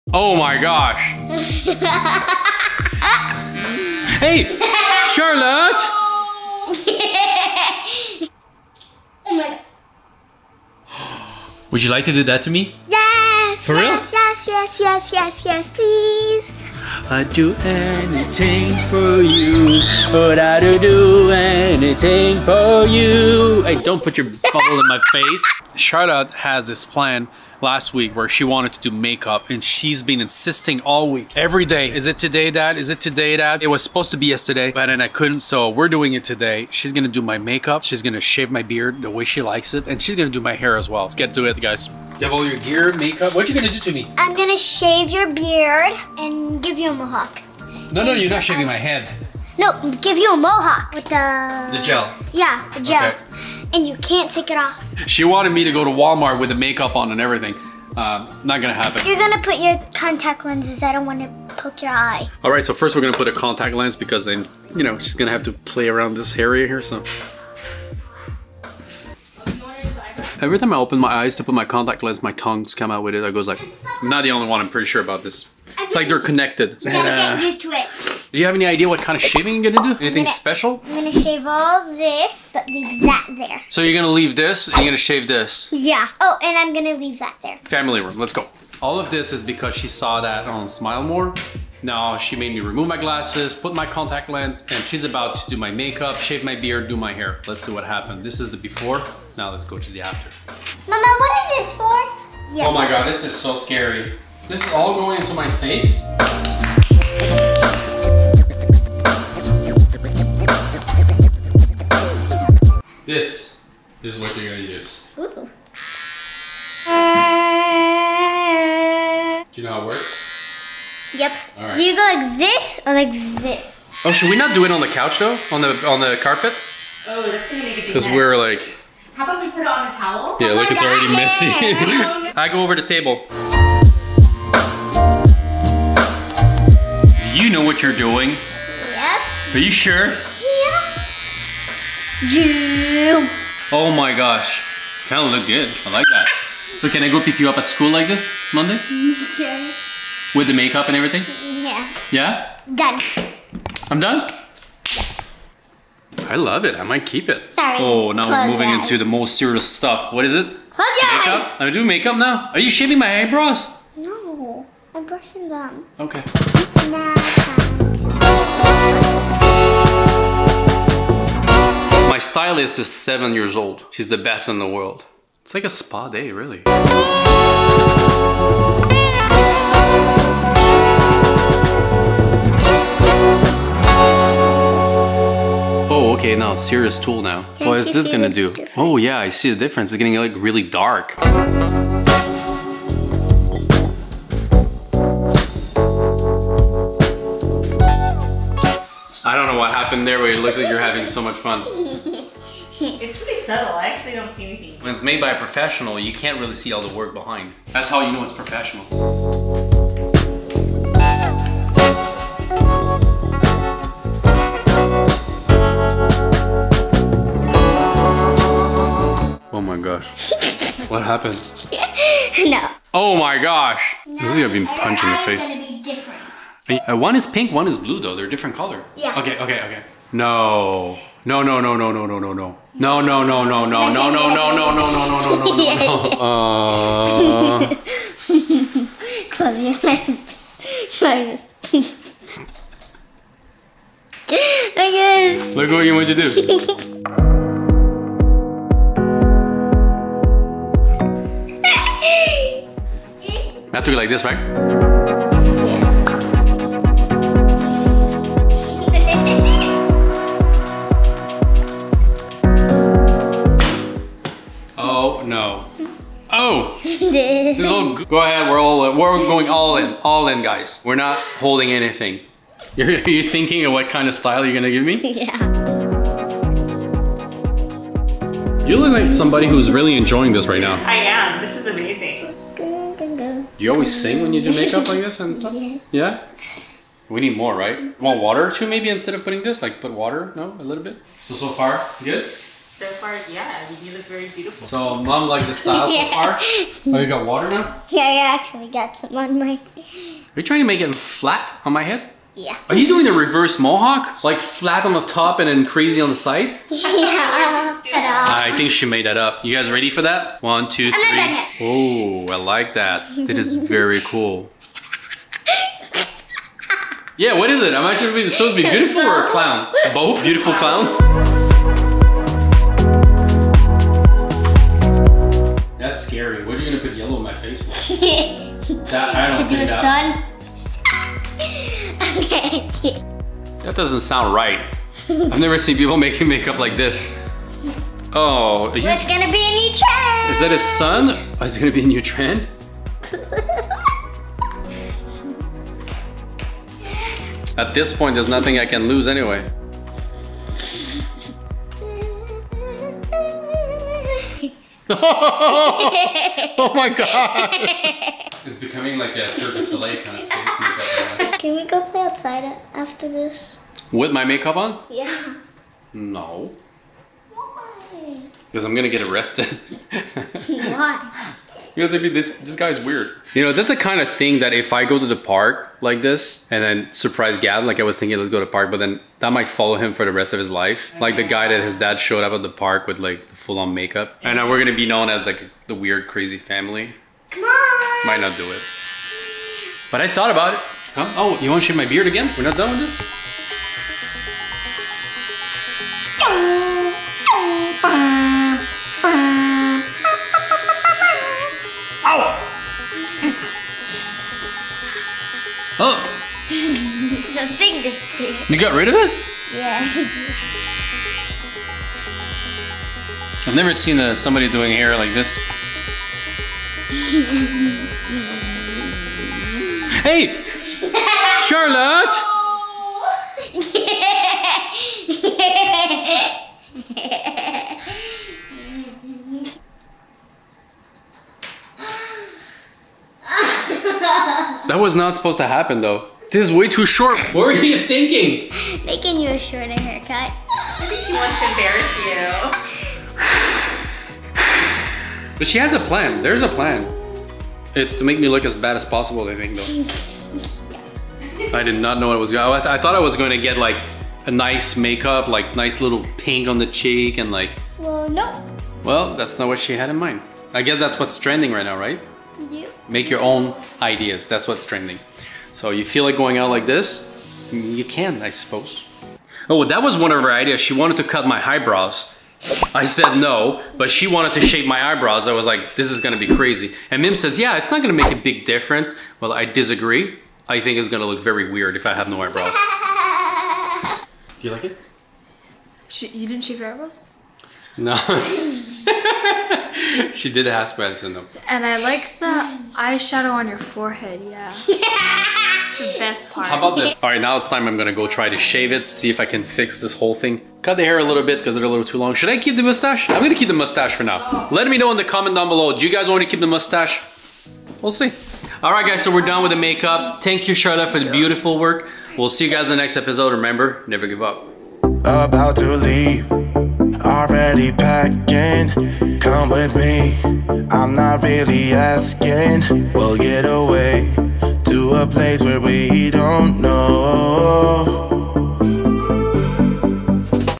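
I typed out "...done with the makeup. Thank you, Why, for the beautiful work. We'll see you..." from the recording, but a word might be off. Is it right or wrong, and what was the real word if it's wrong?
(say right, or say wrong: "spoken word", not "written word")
wrong: "Charlotte", not "Why".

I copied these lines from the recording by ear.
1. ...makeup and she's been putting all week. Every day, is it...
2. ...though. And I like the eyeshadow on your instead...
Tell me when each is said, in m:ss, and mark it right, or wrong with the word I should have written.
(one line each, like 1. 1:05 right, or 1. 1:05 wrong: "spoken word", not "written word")
1. 0:28 wrong: "insisting", not "putting"
2. 8:11 wrong: "forehead", not "instead".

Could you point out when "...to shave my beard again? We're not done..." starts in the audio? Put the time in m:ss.
6:31.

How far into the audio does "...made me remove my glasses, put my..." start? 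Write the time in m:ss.
1:32.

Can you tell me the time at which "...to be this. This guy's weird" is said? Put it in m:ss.
6:11.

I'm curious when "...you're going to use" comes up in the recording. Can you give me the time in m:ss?
1:54.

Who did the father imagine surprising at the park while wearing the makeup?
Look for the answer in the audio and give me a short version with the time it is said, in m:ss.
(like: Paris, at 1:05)
Gavin, at 6:17.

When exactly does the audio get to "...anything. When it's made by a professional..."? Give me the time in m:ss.
3:24.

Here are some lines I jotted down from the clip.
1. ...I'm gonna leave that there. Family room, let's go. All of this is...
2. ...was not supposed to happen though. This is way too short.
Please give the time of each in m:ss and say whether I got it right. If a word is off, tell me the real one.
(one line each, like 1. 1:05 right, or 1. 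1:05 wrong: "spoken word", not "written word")
1. 1:26 right
2. 7:14 right.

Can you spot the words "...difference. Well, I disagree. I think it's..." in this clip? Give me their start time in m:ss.
7:58.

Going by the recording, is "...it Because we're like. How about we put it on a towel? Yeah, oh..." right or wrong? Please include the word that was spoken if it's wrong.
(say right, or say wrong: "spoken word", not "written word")
right.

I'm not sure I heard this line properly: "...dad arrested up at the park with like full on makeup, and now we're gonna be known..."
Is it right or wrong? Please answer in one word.
wrong.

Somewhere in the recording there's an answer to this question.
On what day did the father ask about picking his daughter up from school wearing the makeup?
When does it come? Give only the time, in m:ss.
2:28.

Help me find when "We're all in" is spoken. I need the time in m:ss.
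4:28.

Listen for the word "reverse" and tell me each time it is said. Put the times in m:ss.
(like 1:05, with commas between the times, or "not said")
5:03.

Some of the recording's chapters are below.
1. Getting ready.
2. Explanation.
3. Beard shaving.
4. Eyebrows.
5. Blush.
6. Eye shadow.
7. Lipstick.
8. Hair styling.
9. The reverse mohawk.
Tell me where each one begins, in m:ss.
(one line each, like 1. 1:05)
1. 1:00
2. 1:20
3. 1:55
4. 2:35
5. 3:10
6. 3:30
7. 3:50
8. 4:20
9. 5:00.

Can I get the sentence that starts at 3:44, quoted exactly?
No, this is gonna be punched in the face.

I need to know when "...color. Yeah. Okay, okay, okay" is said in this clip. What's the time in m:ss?
3:48.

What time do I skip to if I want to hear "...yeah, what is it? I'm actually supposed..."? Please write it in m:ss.
5:17.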